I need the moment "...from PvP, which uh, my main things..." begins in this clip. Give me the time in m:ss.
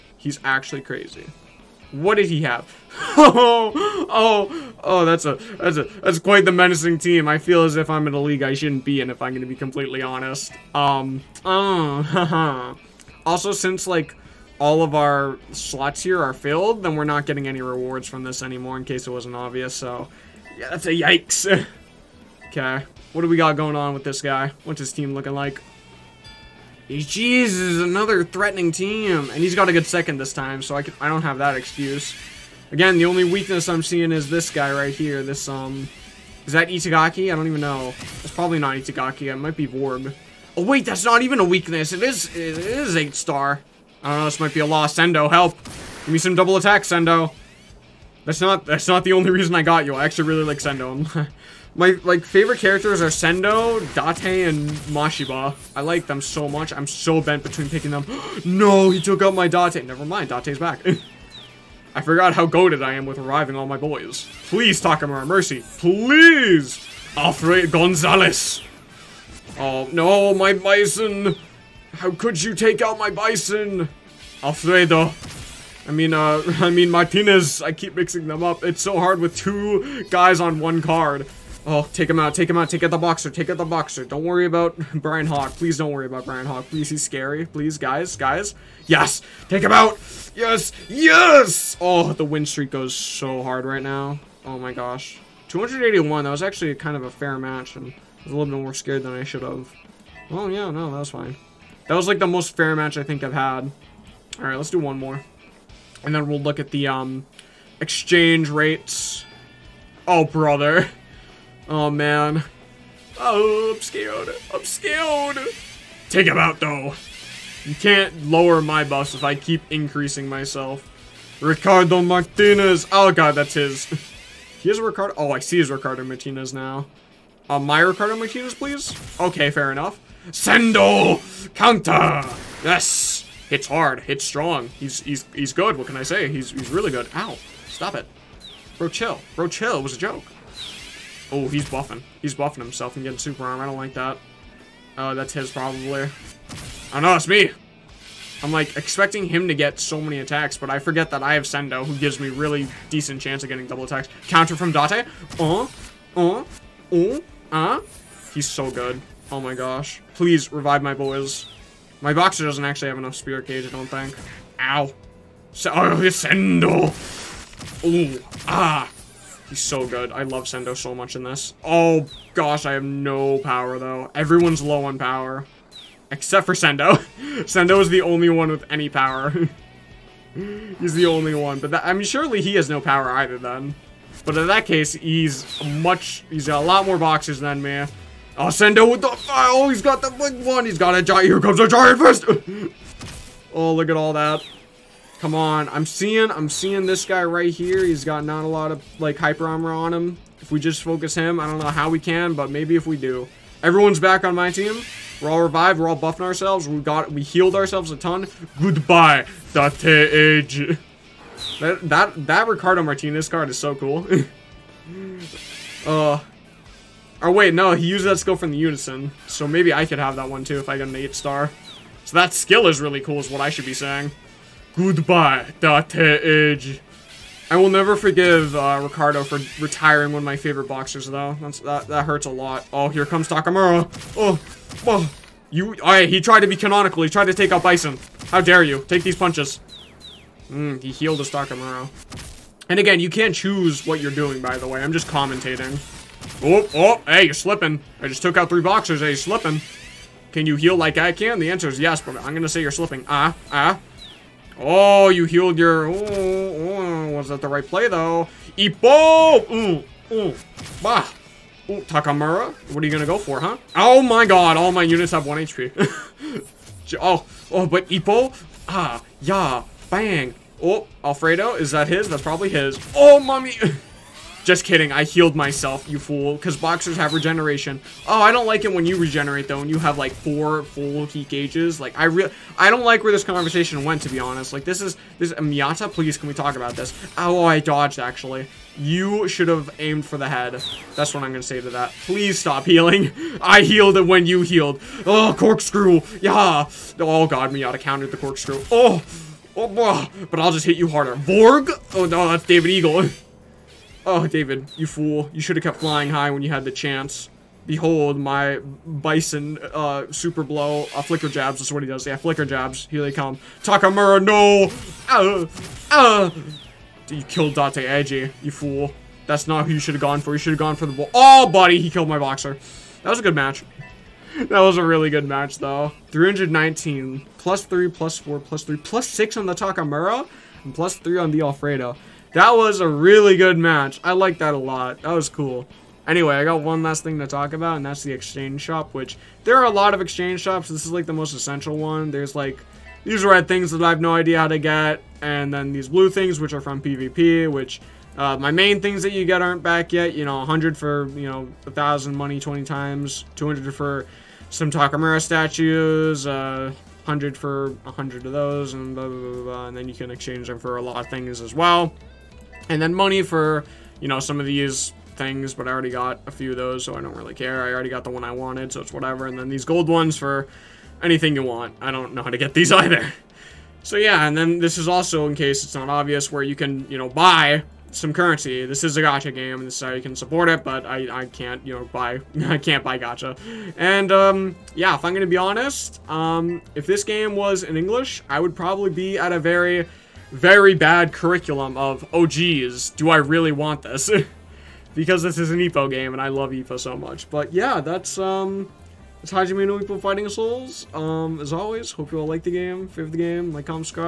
5:46.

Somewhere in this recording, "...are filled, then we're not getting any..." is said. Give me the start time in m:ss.
0:16.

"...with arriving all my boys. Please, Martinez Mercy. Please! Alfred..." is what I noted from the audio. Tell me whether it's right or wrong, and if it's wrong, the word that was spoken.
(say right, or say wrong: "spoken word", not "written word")
wrong: "Takamura", not "Martinez".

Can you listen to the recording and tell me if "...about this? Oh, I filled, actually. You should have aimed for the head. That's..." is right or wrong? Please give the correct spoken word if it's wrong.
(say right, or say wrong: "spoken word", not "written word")
wrong: "dodged", not "filled".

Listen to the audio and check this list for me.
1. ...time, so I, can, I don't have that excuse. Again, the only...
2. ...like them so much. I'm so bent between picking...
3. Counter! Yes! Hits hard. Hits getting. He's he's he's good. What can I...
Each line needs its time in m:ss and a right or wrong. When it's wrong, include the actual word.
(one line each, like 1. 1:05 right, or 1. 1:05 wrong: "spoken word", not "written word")
1. 0:30 right
2. 0:55 right
3. 2:11 wrong: "strong", not "getting".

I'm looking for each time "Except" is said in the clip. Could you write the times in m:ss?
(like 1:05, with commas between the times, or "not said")
2:56.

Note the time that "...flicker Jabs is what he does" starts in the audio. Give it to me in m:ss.
5:11.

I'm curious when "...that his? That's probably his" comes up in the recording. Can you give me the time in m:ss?
4:31.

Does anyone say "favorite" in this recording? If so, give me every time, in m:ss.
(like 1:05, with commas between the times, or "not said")
0:52, 3:50, 6:42.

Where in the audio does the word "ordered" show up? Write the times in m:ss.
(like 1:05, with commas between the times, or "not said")
not said.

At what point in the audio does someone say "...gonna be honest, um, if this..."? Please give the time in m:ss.
6:25.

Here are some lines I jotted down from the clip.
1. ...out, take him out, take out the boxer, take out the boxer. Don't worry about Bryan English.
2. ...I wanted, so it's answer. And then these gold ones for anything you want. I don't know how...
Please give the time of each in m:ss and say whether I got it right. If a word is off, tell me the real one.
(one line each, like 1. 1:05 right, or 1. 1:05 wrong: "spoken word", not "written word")
1. 1:22 wrong: "Hawk", not "English"
2. 6:08 wrong: "whatever", not "answer".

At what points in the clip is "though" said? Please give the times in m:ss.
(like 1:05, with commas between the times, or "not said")
1:56, 2:53, 3:51, 4:17, 4:39, 5:25.